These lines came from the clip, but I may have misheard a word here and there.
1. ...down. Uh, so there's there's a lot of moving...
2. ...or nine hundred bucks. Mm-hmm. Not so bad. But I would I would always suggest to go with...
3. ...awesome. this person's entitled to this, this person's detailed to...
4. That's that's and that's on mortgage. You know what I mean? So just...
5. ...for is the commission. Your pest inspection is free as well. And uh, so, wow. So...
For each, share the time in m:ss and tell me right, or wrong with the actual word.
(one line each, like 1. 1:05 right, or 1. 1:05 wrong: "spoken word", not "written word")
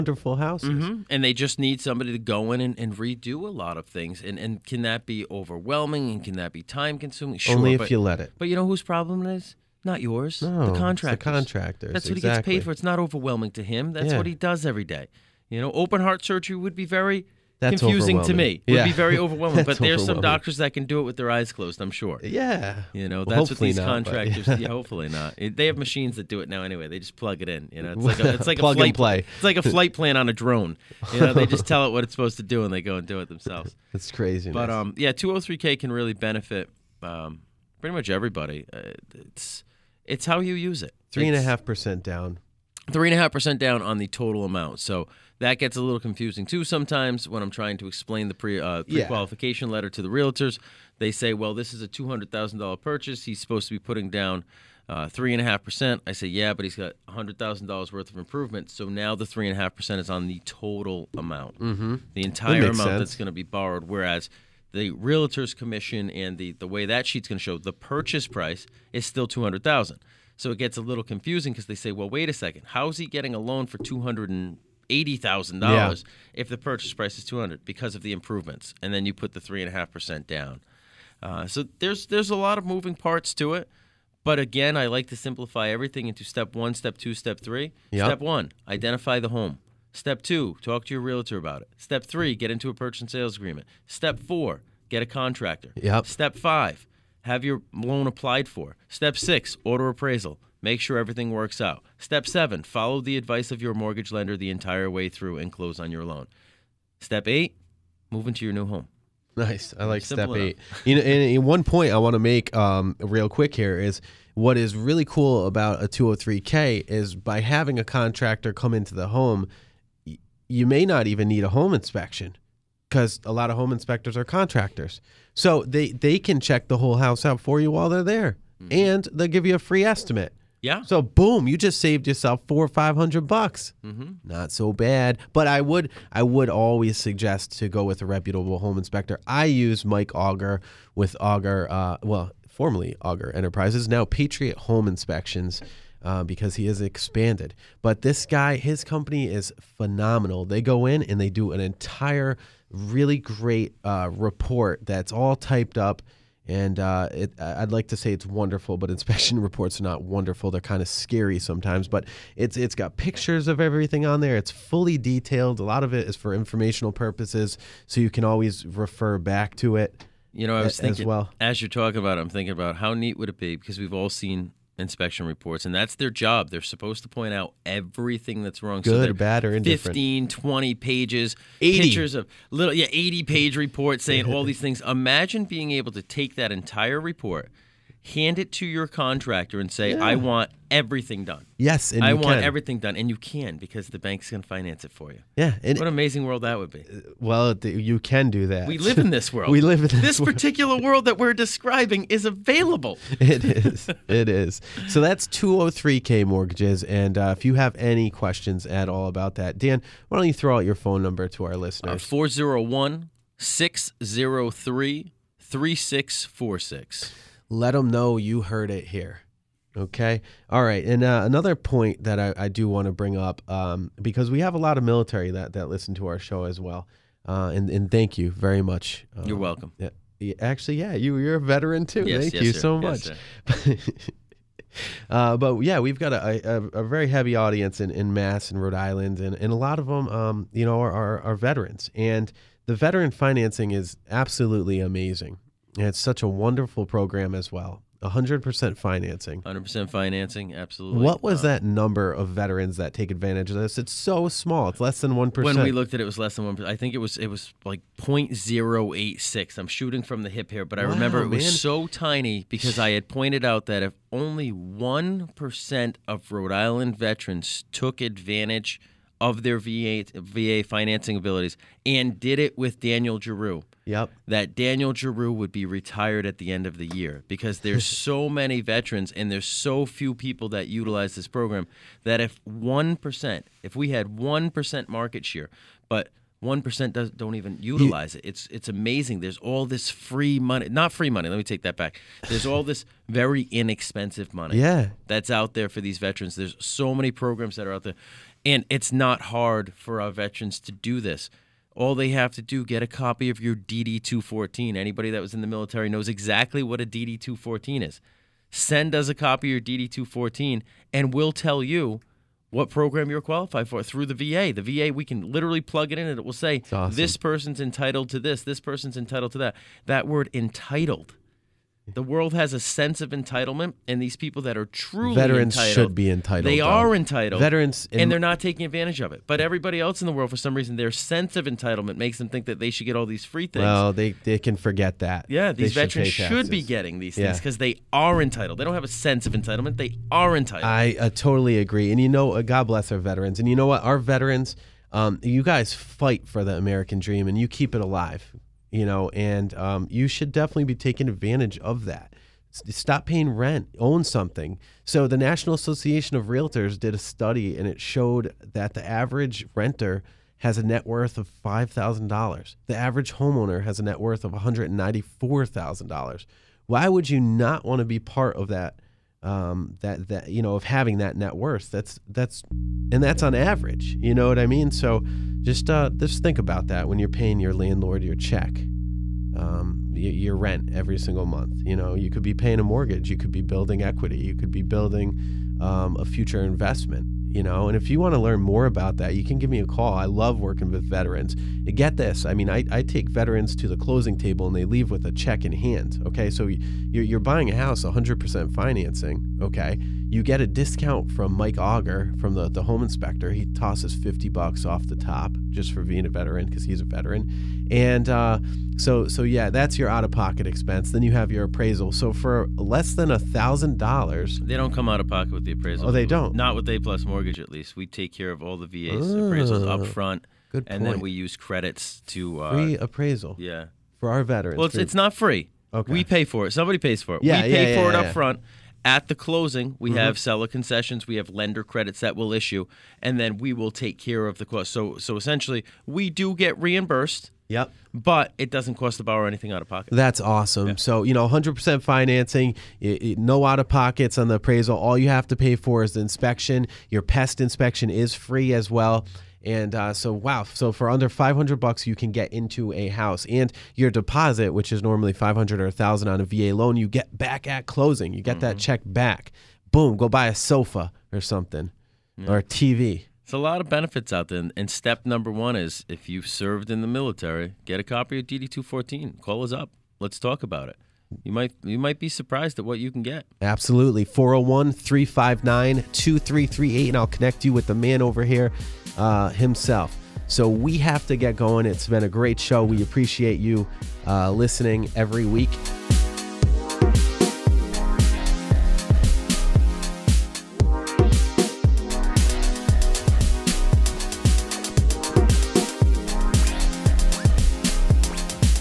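1. 1:20 right
2. 2:12 wrong: "five", not "nine"
3. 5:16 wrong: "entitled", not "detailed"
4. 6:11 wrong: "average", not "mortgage"
5. 7:25 wrong: "inspection", not "commission".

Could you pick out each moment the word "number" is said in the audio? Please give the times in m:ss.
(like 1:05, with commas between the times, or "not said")
3:31, 4:11, 7:45.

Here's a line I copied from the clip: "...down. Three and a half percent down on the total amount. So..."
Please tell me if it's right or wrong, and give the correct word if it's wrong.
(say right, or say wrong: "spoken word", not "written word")
right.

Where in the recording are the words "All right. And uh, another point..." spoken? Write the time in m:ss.
3:40.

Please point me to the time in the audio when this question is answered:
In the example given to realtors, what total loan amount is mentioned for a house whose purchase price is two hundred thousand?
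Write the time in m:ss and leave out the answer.
1:13.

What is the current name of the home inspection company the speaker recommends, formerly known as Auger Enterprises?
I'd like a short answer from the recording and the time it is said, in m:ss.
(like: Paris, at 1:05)
Patriot Home Inspections, at 2:24.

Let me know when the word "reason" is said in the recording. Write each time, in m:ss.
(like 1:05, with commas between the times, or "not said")
5:30.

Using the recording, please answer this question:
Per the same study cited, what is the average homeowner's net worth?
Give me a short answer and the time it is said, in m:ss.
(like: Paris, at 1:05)
$194,000, at 6:04.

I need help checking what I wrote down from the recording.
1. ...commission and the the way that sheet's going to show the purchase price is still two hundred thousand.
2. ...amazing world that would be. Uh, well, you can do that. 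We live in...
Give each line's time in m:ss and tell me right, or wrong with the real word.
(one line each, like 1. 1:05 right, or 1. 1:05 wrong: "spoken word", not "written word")
1. 1:05 right
2. 3:15 right.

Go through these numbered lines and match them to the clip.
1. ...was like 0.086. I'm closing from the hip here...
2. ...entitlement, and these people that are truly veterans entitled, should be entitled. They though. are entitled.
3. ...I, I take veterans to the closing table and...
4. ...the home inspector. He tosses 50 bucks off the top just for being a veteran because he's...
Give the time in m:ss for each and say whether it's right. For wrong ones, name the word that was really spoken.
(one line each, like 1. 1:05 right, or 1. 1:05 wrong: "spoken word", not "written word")
1. 4:17 wrong: "shooting", not "closing"
2. 5:23 right
3. 6:32 right
4. 6:42 right.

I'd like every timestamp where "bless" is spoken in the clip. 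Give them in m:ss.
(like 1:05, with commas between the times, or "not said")
5:42.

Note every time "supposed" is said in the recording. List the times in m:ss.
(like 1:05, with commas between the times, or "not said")
0:32, 0:53, 2:56.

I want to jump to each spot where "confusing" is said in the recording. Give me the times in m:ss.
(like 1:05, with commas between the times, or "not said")
0:17, 0:45, 1:11.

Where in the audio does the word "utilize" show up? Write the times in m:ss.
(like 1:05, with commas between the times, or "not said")
4:40, 4:47.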